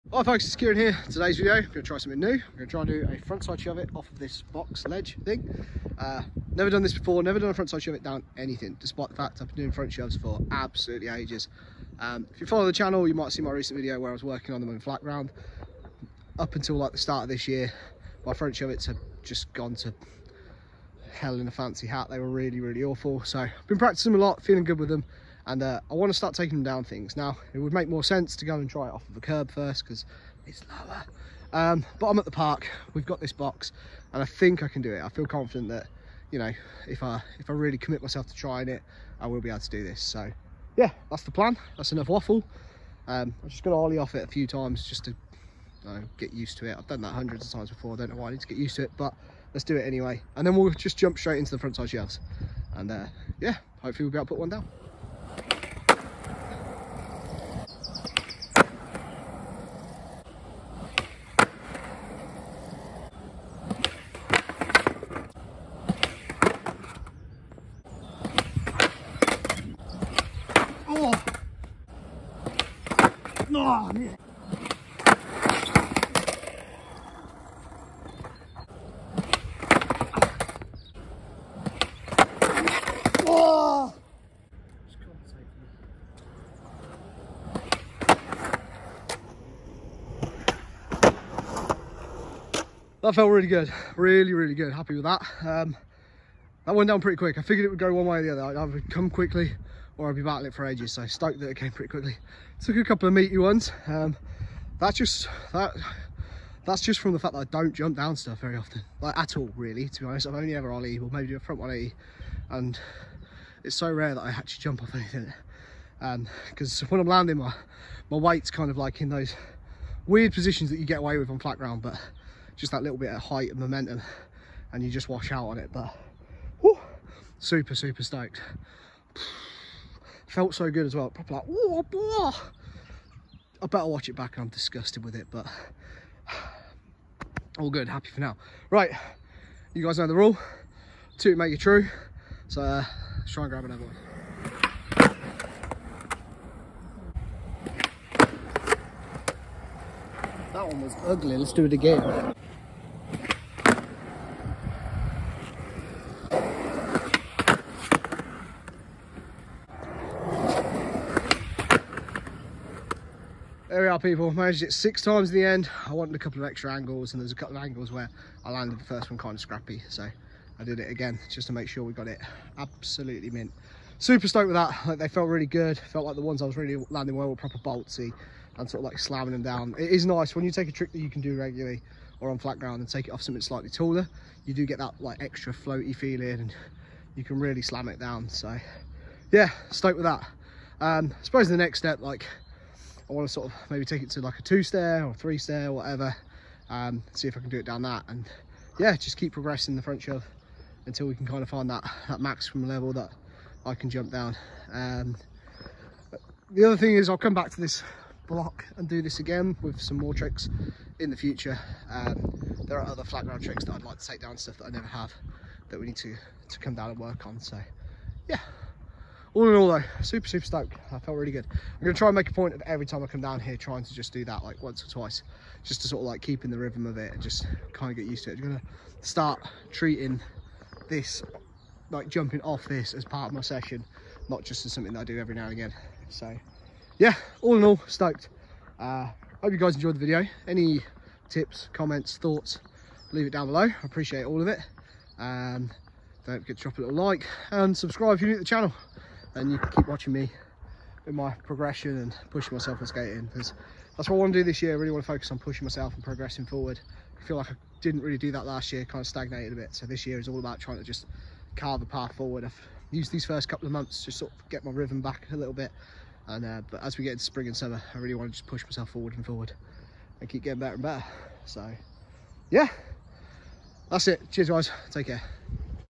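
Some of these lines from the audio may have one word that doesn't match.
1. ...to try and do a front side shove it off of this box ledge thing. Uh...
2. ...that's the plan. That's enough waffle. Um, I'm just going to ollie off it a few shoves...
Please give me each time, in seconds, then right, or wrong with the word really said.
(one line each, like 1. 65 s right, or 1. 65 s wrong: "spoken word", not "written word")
1. 2 s right
2. 41 s wrong: "times", not "shoves".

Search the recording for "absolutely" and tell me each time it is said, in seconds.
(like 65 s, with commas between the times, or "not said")
10 s, 172 s.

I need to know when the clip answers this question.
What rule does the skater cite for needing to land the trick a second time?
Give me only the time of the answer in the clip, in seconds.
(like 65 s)
141 s.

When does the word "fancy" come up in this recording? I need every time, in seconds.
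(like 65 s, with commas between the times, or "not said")
21 s.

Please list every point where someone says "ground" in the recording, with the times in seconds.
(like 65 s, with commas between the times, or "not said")
15 s, 121 s, 182 s, 213 s.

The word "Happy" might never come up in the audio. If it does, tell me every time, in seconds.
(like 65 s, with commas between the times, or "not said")
94 s, 137 s.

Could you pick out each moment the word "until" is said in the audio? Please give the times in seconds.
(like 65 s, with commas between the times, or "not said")
16 s, 200 s.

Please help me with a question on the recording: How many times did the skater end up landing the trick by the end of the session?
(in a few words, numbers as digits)
6.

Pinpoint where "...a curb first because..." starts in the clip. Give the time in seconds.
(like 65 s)
29 s.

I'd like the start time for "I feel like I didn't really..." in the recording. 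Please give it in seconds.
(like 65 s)
257 s.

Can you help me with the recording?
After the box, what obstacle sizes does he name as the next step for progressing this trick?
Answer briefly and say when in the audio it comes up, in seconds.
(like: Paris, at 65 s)
Two stair or three stair, at 194 s.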